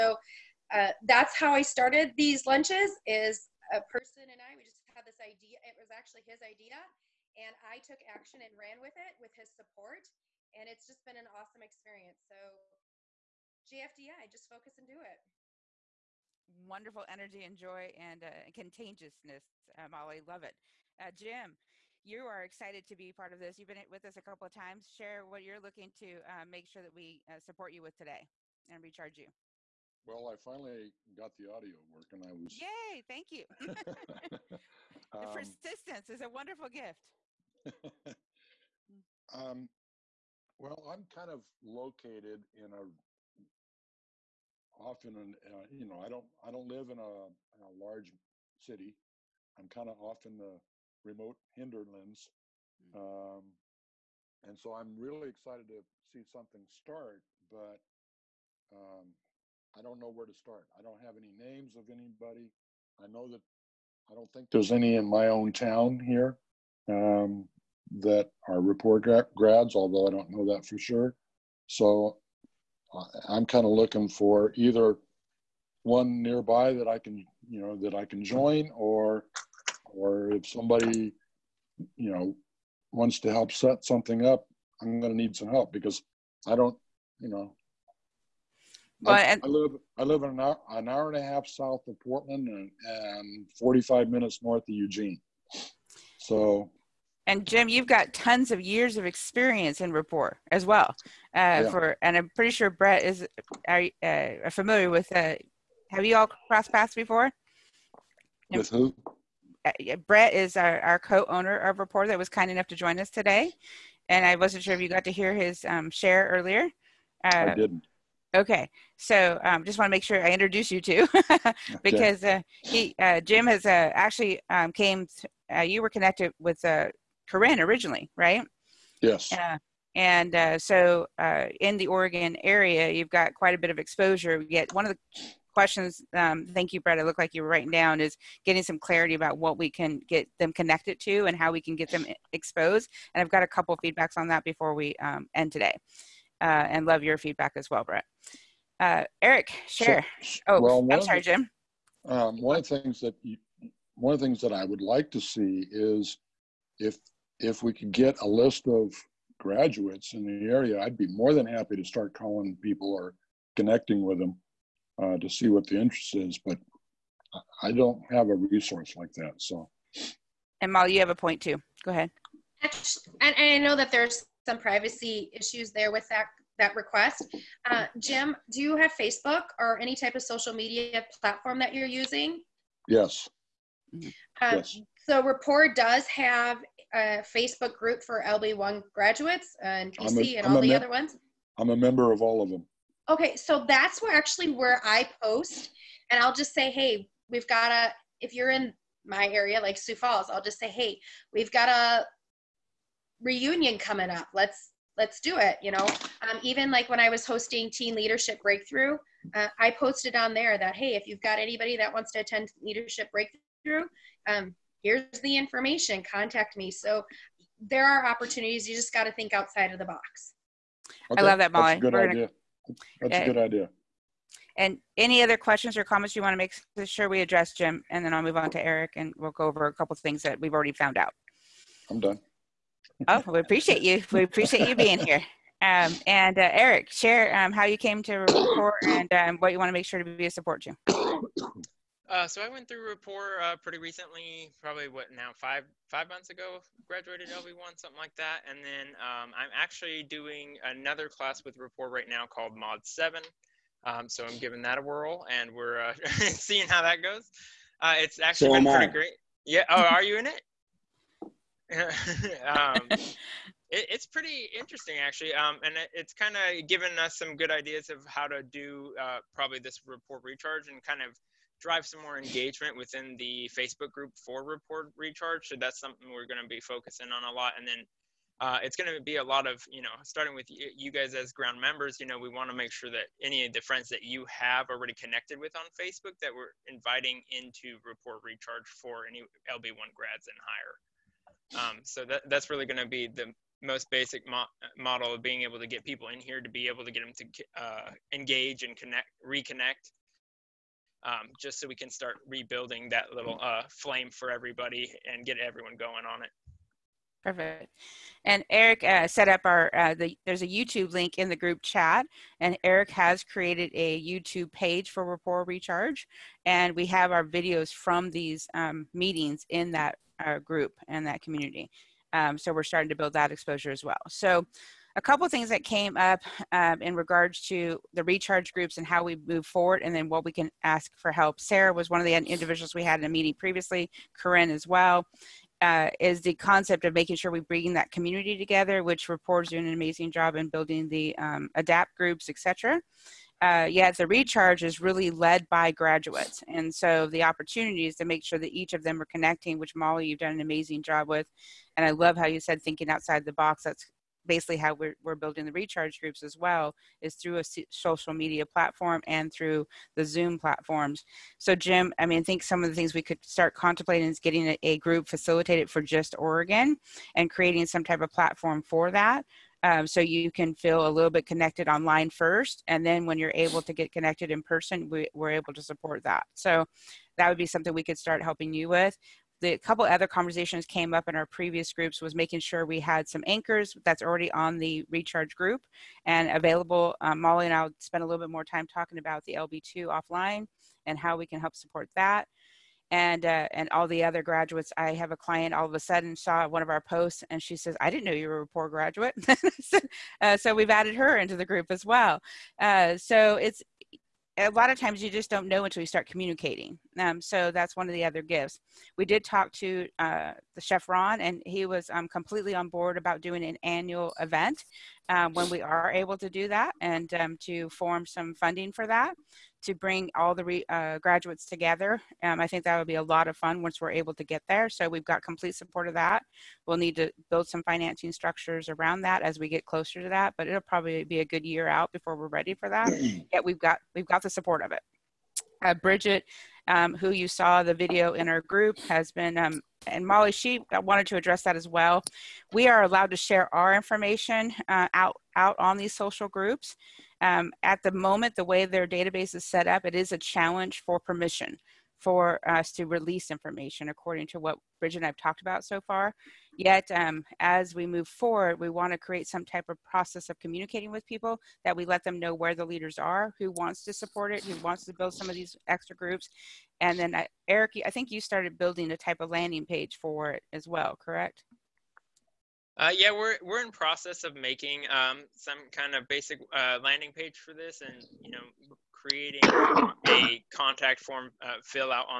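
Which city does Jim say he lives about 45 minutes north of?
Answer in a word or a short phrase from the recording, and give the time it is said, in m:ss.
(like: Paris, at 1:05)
Eugene, at 1:34.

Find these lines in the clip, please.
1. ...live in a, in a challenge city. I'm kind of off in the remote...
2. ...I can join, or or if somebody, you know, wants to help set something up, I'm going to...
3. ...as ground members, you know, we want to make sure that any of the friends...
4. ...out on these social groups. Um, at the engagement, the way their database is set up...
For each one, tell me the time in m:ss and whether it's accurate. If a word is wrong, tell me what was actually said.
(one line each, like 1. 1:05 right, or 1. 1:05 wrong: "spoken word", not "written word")
1. 0:46 wrong: "large", not "challenge"
2. 1:17 right
3. 4:41 right
4. 7:25 wrong: "moment", not "engagement".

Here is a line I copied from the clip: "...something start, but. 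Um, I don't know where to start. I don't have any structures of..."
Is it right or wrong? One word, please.
wrong.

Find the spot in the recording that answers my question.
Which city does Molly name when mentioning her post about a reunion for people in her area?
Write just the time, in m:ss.
3:19.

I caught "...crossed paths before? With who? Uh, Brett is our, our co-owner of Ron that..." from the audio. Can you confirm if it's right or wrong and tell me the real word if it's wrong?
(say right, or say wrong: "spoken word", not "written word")
wrong: "Rapport", not "Ron".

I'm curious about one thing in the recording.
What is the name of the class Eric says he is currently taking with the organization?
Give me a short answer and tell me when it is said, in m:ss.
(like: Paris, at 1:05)
Mod Seven, at 4:12.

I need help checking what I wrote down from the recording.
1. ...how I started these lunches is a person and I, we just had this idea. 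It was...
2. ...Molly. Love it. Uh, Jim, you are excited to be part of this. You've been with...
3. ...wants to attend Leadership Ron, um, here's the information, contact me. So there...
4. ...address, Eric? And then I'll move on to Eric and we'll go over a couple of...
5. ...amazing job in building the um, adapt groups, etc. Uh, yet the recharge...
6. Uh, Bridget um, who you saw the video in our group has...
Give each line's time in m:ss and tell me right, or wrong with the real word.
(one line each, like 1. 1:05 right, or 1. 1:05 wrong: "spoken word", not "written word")
1. 0:01 right
2. 0:19 right
3. 3:31 wrong: "Breakthrough", not "Ron"
4. 3:47 wrong: "Jim", not "Eric"
5. 5:39 right
6. 7:15 right.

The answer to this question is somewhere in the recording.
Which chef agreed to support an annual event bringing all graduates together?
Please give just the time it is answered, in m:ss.
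6:50.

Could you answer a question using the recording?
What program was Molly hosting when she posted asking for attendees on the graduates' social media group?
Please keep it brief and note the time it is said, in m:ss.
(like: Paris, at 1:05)
Teen Leadership Breakthrough, at 3:27.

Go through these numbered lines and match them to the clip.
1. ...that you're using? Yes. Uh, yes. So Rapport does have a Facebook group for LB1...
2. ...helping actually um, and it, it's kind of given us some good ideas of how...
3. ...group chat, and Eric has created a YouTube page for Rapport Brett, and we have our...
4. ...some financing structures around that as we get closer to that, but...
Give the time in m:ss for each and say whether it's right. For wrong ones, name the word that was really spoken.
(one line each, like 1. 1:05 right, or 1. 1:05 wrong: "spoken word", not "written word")
1. 3:01 right
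2. 4:24 wrong: "interesting", not "helping"
3. 5:11 wrong: "Recharge", not "Brett"
4. 7:07 right.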